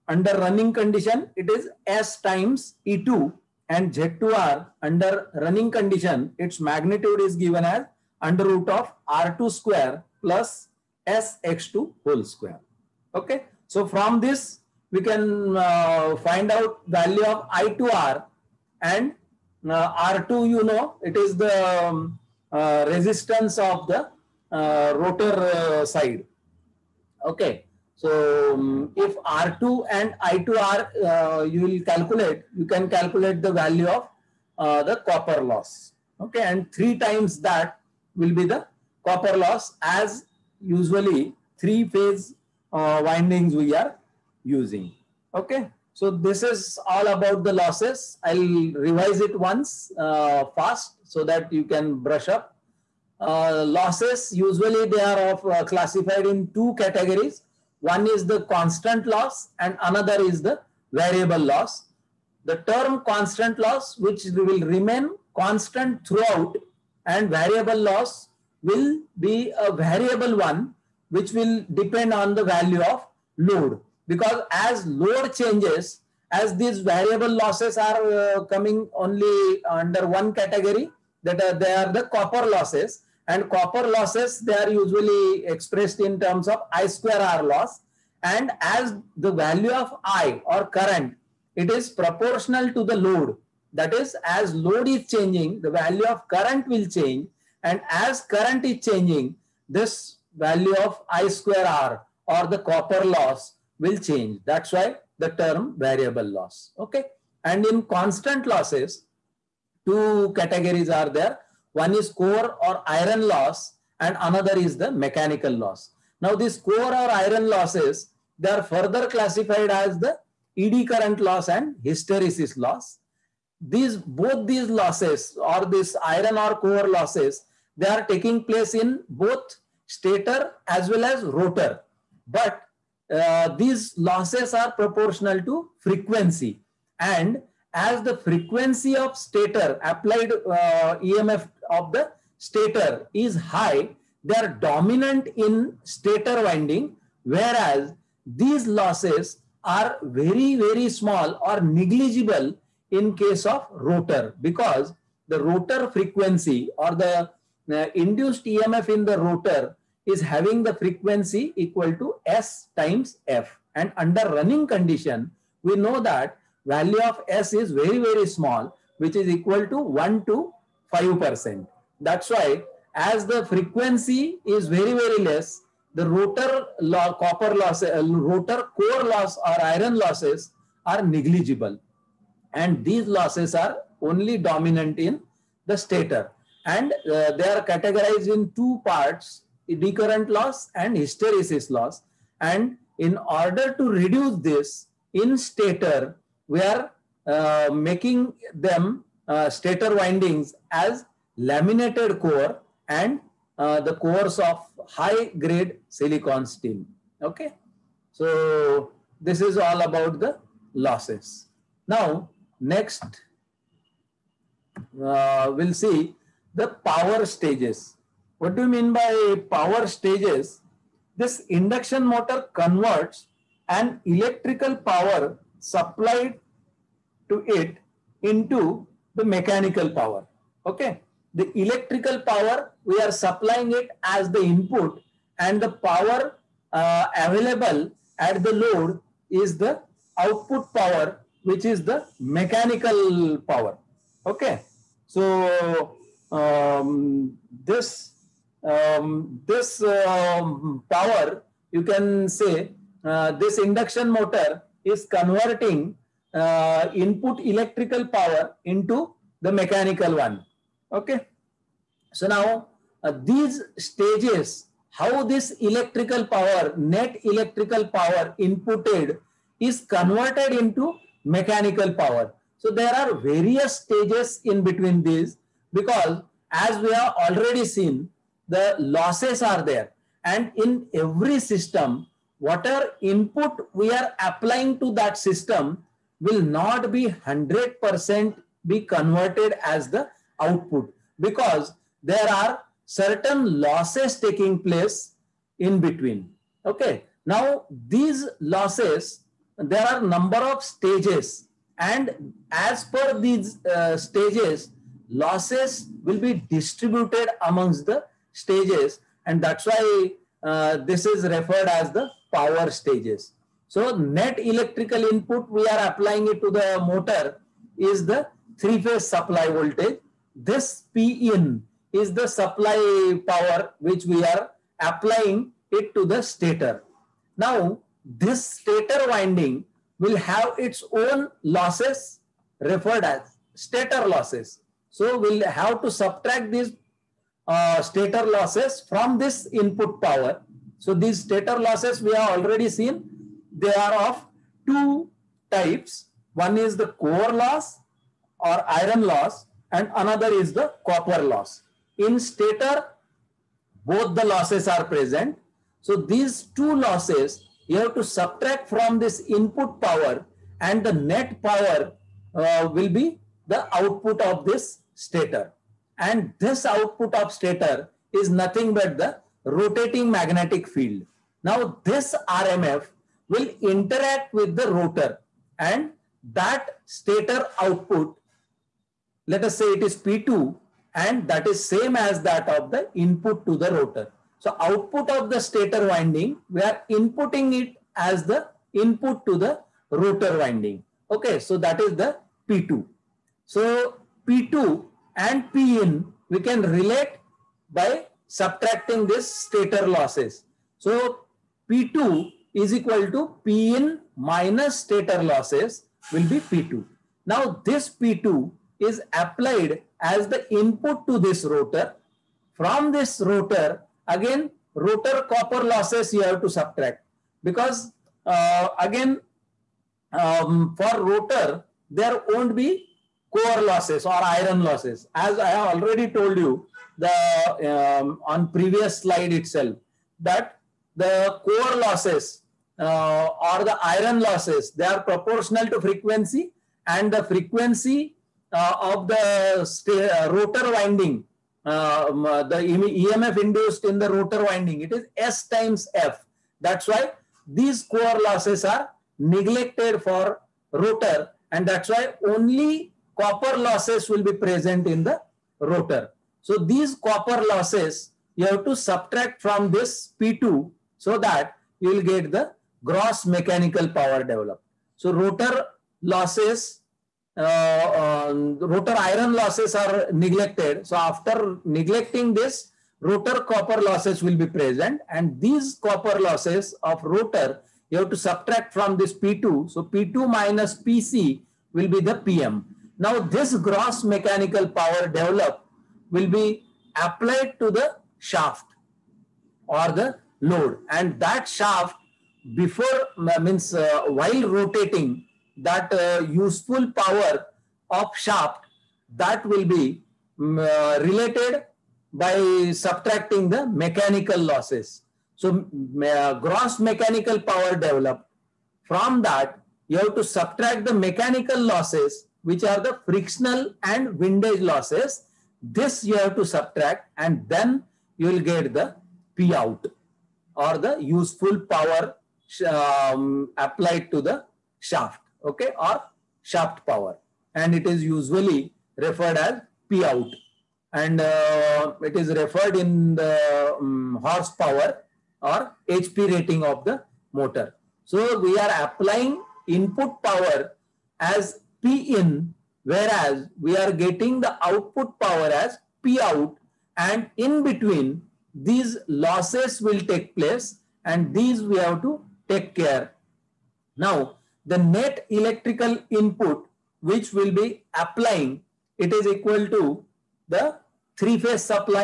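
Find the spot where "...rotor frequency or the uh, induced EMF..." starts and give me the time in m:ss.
2:35.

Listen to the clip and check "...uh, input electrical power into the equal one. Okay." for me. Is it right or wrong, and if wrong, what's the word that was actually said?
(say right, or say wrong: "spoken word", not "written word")
wrong: "mechanical", not "equal".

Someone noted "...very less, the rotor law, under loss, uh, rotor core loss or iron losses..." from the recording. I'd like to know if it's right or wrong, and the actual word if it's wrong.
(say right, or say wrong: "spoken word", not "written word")
wrong: "copper", not "under".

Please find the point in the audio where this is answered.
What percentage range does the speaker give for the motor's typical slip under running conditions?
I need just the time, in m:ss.
2:49.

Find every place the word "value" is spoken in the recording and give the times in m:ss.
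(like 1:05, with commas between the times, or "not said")
0:16, 0:33, 1:12, 1:29, 1:35, 1:40, 2:46.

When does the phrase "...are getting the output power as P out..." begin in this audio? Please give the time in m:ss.
9:03.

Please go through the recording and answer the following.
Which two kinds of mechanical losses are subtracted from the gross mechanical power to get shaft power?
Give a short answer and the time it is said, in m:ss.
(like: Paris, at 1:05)
frictional and windage losses, at 8:33.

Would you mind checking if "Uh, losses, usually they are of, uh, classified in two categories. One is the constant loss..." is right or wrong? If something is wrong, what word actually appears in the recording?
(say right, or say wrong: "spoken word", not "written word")
right.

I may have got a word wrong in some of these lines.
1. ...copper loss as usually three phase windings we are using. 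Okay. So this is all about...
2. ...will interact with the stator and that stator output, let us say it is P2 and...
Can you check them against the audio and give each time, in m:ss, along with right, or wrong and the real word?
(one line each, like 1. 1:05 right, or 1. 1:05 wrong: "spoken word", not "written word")
1. 0:39 right
2. 6:13 wrong: "rotor", not "stator".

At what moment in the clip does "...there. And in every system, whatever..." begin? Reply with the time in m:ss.
4:39.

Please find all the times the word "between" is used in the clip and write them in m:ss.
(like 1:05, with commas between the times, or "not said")
4:34, 4:55, 9:07.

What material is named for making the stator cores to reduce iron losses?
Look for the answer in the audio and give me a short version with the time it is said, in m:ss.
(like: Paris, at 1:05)
high grade silicon steel, at 3:24.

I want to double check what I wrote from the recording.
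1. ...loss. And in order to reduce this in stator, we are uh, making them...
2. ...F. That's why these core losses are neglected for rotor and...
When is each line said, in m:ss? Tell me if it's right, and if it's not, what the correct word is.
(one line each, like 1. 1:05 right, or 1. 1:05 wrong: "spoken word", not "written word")
1. 3:11 right
2. 7:25 right.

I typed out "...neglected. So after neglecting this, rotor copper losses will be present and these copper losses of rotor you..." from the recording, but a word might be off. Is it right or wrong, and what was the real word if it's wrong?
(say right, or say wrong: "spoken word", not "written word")
right.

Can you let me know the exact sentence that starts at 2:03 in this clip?
These both these losses or this iron or core losses, they are taking place in both stator as well as rotor.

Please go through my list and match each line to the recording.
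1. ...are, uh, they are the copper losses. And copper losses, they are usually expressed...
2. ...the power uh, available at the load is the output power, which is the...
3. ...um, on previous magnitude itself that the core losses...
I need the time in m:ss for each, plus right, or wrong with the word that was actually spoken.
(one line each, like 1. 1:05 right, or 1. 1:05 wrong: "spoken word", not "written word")
1. 1:21 right
2. 3:55 right
3. 7:07 wrong: "slide", not "magnitude".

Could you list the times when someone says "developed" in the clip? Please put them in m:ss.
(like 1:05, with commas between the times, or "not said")
7:44, 8:05, 8:27.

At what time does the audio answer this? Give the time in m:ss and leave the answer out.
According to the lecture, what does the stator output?
6:09.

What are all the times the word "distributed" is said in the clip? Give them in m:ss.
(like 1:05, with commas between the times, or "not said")
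5:06.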